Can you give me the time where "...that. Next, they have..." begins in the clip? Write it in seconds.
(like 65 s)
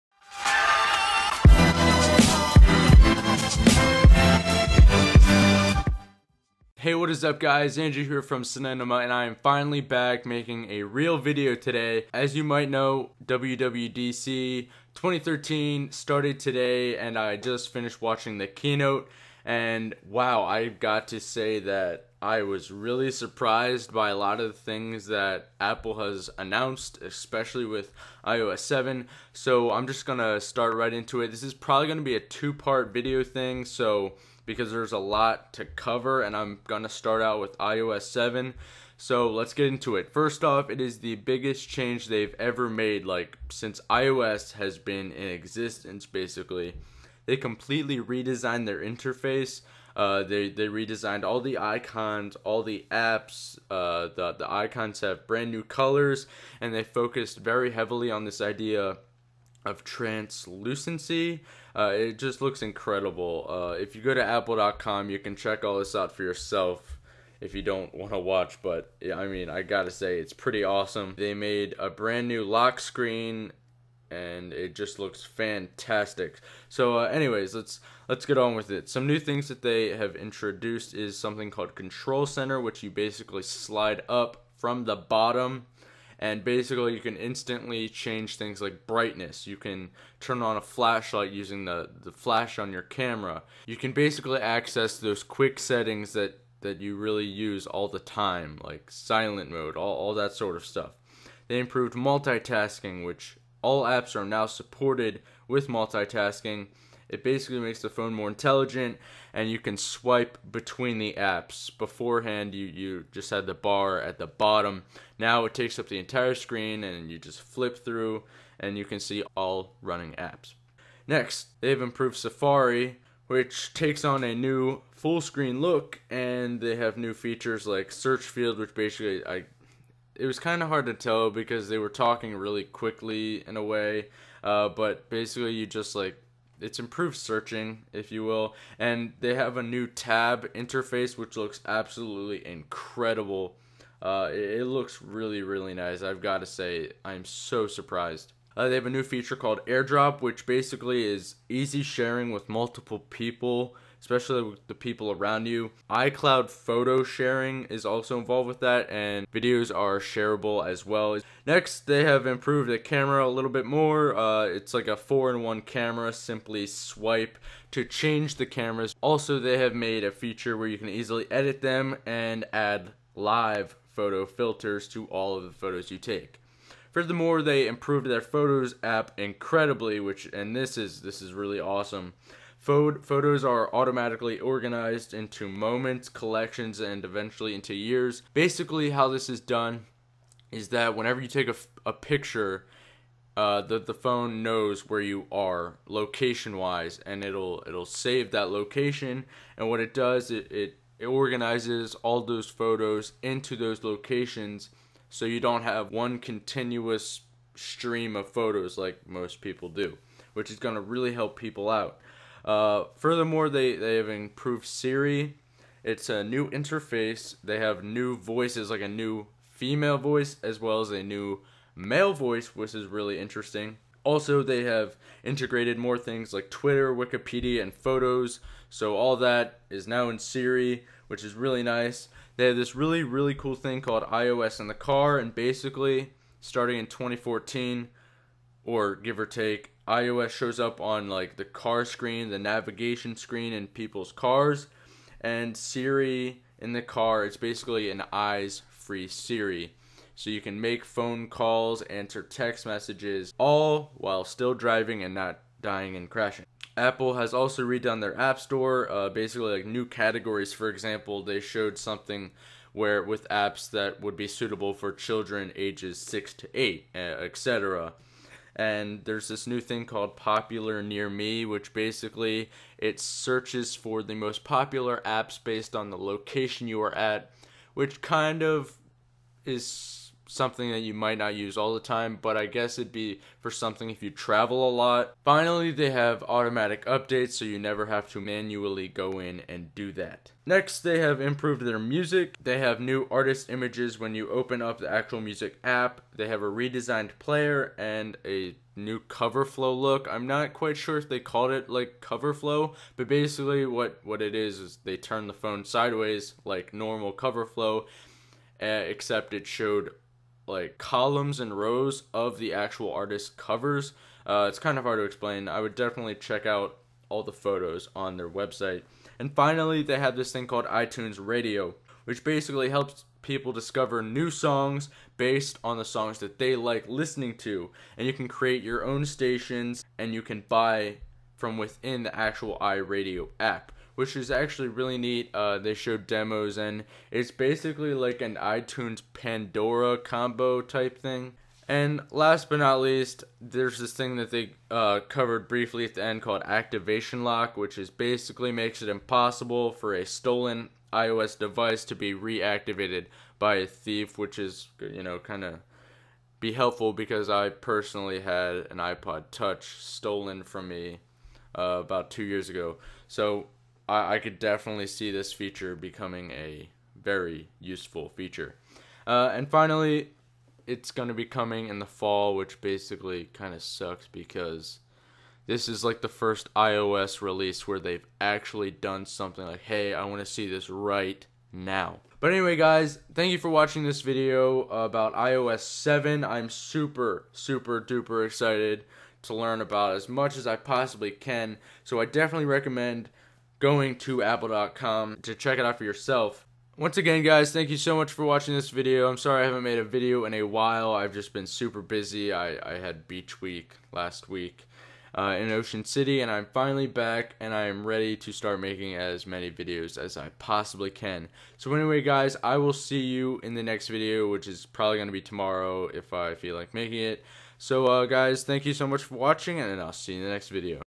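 289 s.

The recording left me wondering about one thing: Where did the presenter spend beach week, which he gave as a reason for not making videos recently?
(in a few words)
Ocean City.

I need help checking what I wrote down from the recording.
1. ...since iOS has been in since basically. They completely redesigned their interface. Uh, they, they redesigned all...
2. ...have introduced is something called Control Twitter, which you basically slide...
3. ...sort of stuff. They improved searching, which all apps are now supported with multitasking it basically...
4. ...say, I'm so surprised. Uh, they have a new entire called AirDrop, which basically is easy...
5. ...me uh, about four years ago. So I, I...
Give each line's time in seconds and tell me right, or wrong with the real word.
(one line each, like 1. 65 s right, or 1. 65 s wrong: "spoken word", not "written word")
1. 43 s wrong: "existence", not "since"
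2. 79 s wrong: "Center", not "Twitter"
3. 100 s wrong: "multitasking", not "searching"
4. 146 s wrong: "feature", not "entire"
5. 360 s wrong: "two", not "four".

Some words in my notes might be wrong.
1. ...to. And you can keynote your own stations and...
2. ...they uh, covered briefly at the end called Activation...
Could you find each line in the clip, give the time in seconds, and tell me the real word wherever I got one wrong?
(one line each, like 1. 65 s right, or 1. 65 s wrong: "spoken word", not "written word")
1. 327 s wrong: "create", not "keynote"
2. 344 s right.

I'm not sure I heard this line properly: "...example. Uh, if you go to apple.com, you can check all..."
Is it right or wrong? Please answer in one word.
wrong.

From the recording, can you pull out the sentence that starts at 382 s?
But anyway, guys, thank you for watching this video about iOS 7.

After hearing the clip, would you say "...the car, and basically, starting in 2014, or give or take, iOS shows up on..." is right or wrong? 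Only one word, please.
right.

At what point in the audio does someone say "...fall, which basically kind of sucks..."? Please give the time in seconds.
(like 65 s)
371 s.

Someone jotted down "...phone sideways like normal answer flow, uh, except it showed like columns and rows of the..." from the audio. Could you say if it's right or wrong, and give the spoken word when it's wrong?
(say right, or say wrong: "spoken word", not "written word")
wrong: "cover", not "answer".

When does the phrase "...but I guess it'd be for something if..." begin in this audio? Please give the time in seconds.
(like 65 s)
282 s.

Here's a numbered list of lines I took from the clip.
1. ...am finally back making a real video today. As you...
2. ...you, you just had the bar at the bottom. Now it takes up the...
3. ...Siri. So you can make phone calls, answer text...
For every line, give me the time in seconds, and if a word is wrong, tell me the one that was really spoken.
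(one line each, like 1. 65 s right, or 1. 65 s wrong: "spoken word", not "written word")
1. 9 s right
2. 112 s right
3. 249 s right.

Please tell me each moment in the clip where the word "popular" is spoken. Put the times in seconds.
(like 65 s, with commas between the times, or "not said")
270 s, 274 s.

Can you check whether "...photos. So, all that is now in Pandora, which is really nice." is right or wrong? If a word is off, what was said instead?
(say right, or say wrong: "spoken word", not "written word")
wrong: "Siri", not "Pandora".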